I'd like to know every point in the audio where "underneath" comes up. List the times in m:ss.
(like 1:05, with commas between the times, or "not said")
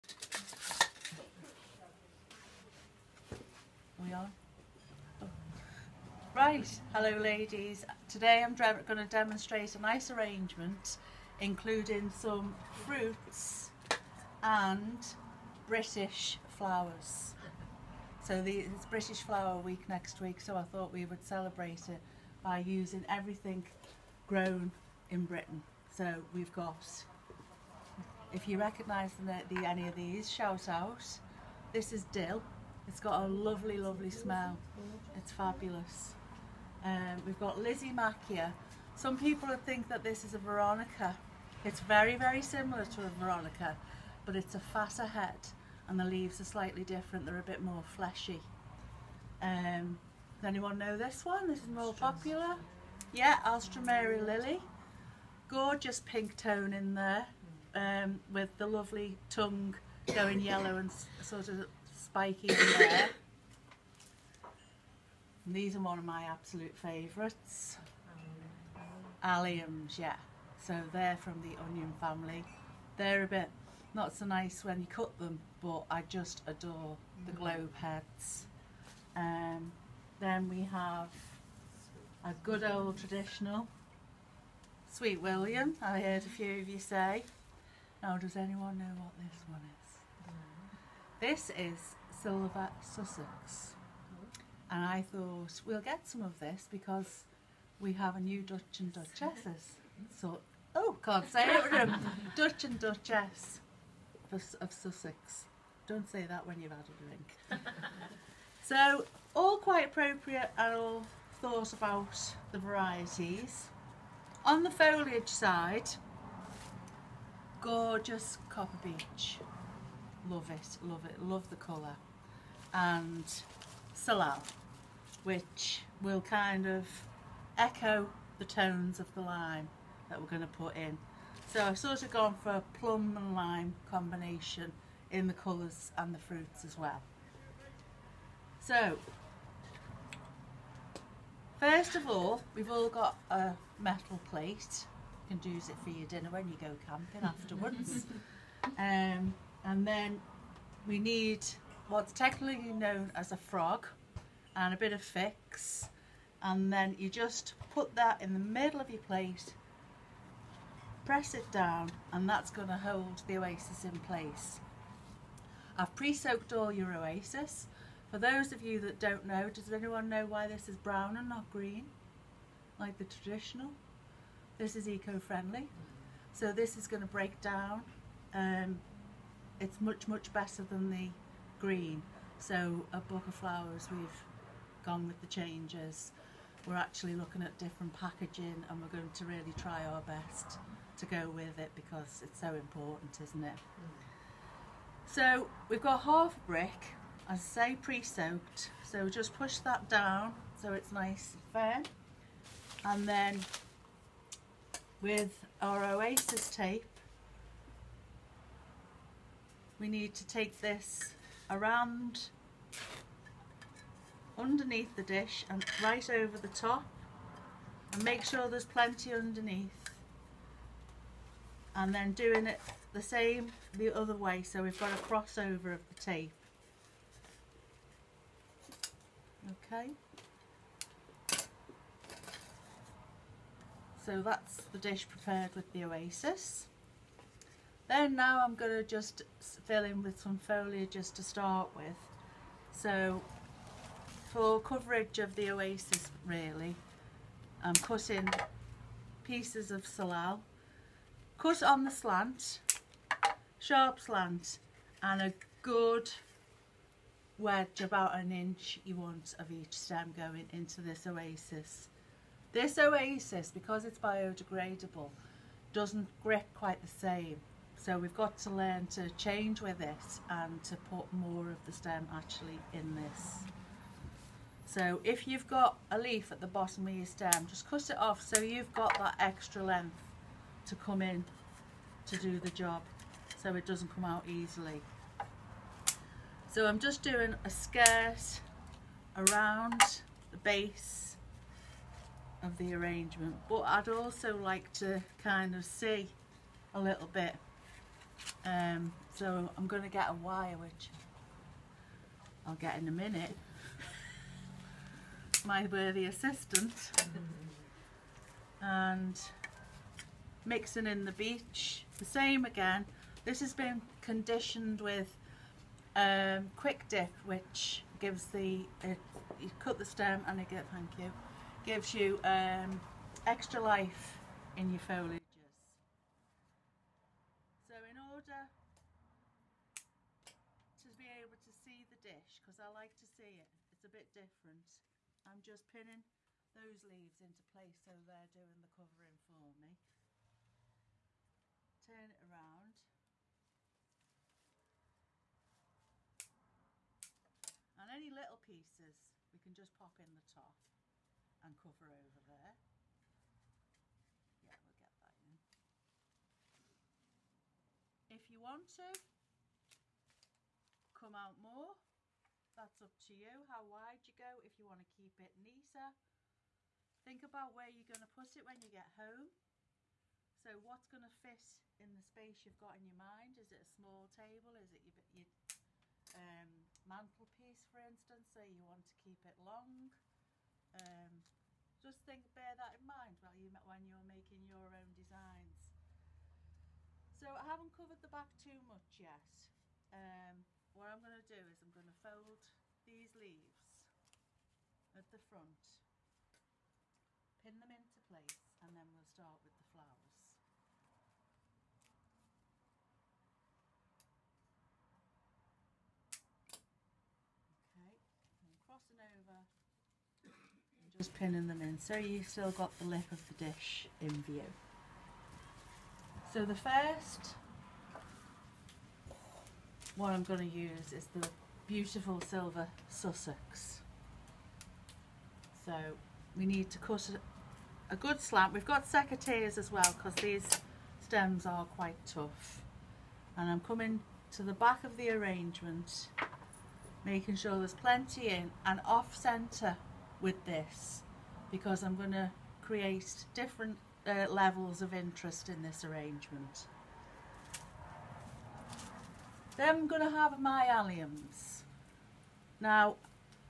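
3:34, 3:39.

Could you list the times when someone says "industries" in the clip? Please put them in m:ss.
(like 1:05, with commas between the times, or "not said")
not said.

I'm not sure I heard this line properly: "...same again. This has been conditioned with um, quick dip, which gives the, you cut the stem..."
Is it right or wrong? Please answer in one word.
right.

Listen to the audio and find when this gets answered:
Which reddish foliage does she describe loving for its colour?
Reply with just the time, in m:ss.
1:58.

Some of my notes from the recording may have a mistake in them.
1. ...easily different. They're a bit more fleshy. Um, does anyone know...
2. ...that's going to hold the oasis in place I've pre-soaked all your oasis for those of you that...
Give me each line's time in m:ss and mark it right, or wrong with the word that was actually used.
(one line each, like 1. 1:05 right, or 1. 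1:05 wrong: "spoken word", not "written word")
1. 0:46 wrong: "slightly", not "easily"
2. 2:42 right.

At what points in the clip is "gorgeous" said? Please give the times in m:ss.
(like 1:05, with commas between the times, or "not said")
0:55, 1:57.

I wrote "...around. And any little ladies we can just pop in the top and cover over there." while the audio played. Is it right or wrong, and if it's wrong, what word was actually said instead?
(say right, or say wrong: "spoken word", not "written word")
wrong: "pieces", not "ladies".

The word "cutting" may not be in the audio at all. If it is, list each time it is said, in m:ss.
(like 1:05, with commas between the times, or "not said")
4:07.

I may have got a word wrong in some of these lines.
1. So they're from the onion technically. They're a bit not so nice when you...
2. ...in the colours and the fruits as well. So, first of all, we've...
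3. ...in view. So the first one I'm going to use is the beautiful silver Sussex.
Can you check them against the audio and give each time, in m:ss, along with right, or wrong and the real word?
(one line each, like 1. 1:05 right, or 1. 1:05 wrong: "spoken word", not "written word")
1. 1:10 wrong: "family", not "technically"
2. 2:15 right
3. 6:54 right.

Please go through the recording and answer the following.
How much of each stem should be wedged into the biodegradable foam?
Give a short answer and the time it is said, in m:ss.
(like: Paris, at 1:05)
About an inch, at 4:17.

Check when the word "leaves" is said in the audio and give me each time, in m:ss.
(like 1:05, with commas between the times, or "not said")
0:46, 5:36, 6:33.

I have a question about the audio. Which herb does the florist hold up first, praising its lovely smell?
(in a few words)
Dill.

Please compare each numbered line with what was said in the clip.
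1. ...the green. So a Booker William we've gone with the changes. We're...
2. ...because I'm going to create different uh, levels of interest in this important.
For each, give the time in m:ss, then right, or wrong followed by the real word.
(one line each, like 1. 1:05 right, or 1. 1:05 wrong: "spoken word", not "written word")
1. 3:00 wrong: "Flowers", not "William"
2. 7:21 wrong: "arrangement", not "important".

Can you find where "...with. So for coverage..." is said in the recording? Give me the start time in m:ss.
4:01.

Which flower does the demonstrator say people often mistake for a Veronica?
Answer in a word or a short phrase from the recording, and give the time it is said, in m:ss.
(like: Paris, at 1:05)
Lysimachia, at 0:37.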